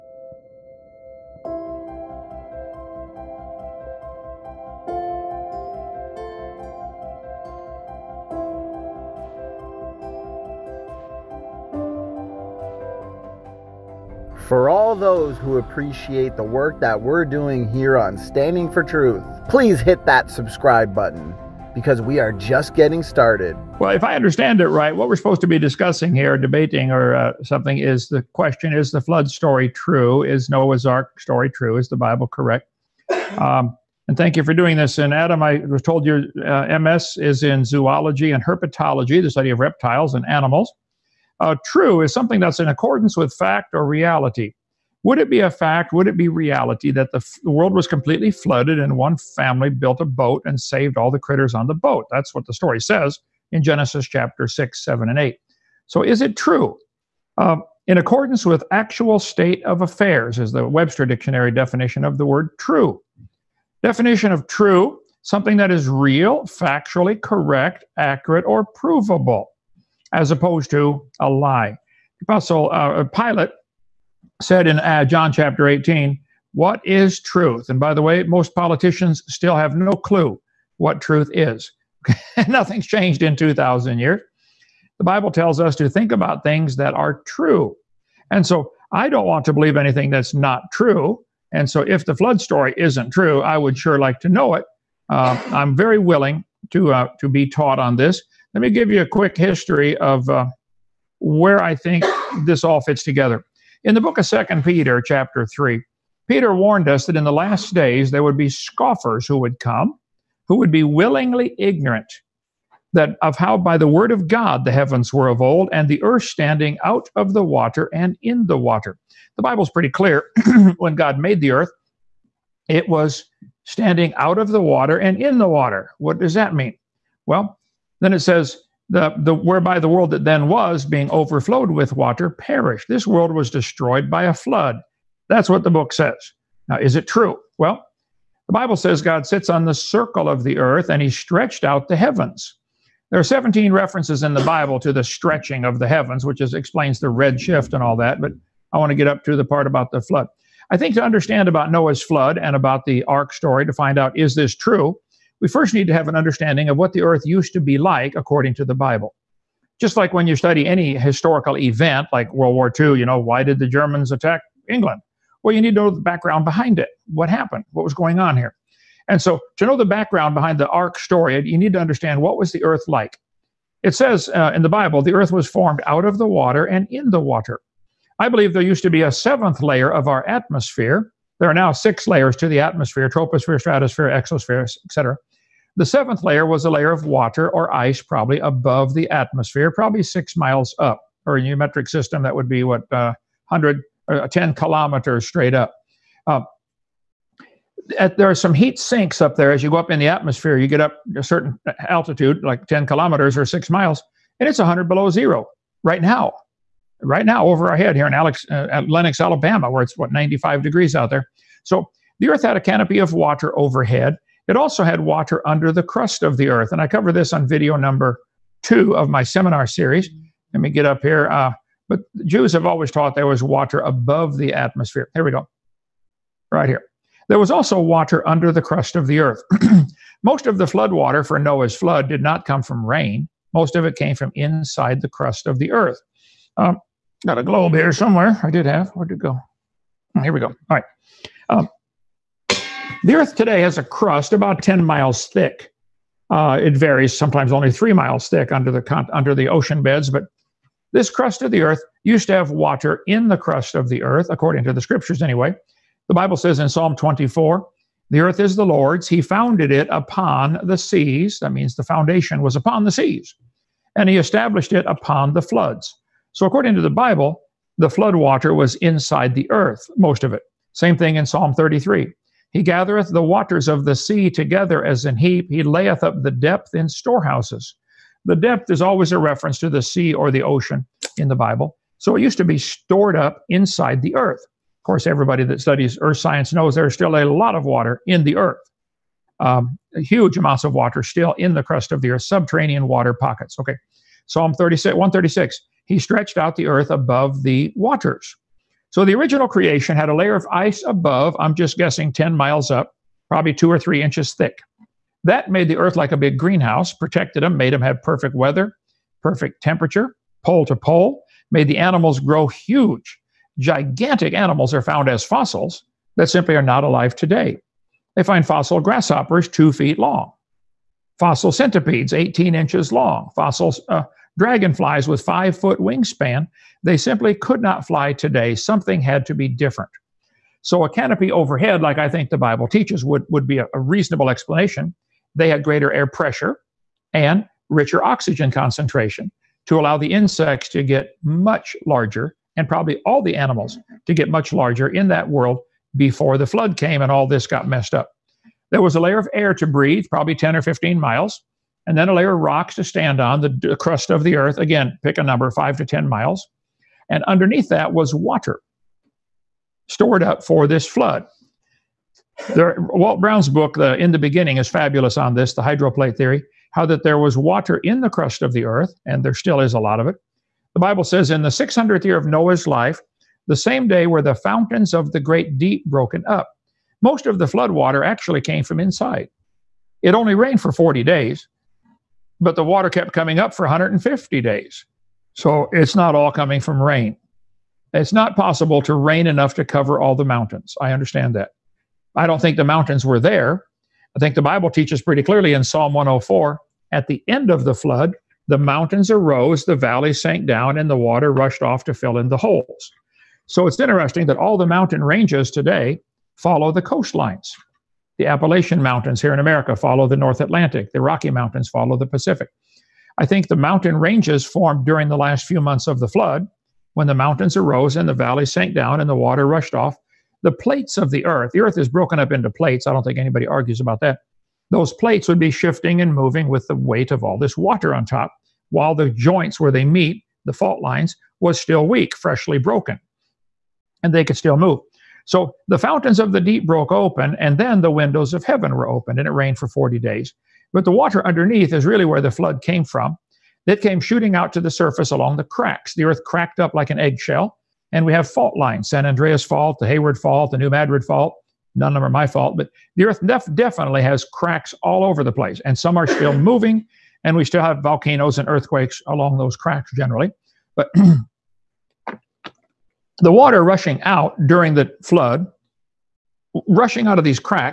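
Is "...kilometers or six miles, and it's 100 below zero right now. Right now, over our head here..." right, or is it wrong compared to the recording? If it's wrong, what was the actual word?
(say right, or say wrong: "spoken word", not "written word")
right.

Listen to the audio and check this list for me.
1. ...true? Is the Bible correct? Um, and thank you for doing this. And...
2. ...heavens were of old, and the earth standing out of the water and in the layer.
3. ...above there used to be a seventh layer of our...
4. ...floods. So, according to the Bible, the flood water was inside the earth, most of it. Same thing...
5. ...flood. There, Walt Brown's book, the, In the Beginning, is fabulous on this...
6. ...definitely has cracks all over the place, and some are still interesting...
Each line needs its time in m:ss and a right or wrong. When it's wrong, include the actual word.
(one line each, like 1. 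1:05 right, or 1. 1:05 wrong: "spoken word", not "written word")
1. 0:31 right
2. 1:54 wrong: "water", not "layer"
3. 2:58 wrong: "believe", not "above"
4. 4:25 right
5. 6:00 right
6. 7:33 wrong: "moving", not "interesting".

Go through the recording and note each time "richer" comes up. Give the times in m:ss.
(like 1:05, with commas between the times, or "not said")
5:37.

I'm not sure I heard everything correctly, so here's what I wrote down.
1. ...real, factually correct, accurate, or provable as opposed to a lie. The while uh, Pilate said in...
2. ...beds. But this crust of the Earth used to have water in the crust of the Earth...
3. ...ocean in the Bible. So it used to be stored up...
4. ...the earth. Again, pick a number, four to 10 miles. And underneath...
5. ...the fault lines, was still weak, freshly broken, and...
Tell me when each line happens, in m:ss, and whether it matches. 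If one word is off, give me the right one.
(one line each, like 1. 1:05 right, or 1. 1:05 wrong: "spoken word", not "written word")
1. 1:05 wrong: "apostle", not "while"
2. 4:09 right
3. 4:40 right
4. 5:54 wrong: "five", not "four"
5. 7:10 right.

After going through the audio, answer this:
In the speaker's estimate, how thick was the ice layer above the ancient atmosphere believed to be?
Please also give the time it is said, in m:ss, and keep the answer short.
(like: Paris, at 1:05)
two or three inches, at 5:03.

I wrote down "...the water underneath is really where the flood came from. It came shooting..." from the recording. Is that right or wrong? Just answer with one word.
right.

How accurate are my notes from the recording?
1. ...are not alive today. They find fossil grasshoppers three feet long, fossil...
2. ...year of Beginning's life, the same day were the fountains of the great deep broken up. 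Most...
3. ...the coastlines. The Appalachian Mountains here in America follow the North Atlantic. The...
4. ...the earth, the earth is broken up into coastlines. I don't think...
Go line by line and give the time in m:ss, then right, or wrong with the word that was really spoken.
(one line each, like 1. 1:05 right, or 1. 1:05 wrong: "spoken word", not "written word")
1. 5:16 wrong: "two", not "three"
2. 6:12 wrong: "Noah", not "Beginning"
3. 6:46 right
4. 7:01 wrong: "plates", not "coastlines".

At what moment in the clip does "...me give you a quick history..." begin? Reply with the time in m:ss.
1:38.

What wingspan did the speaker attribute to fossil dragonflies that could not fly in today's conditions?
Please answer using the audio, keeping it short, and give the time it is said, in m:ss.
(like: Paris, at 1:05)
5 feet, at 5:25.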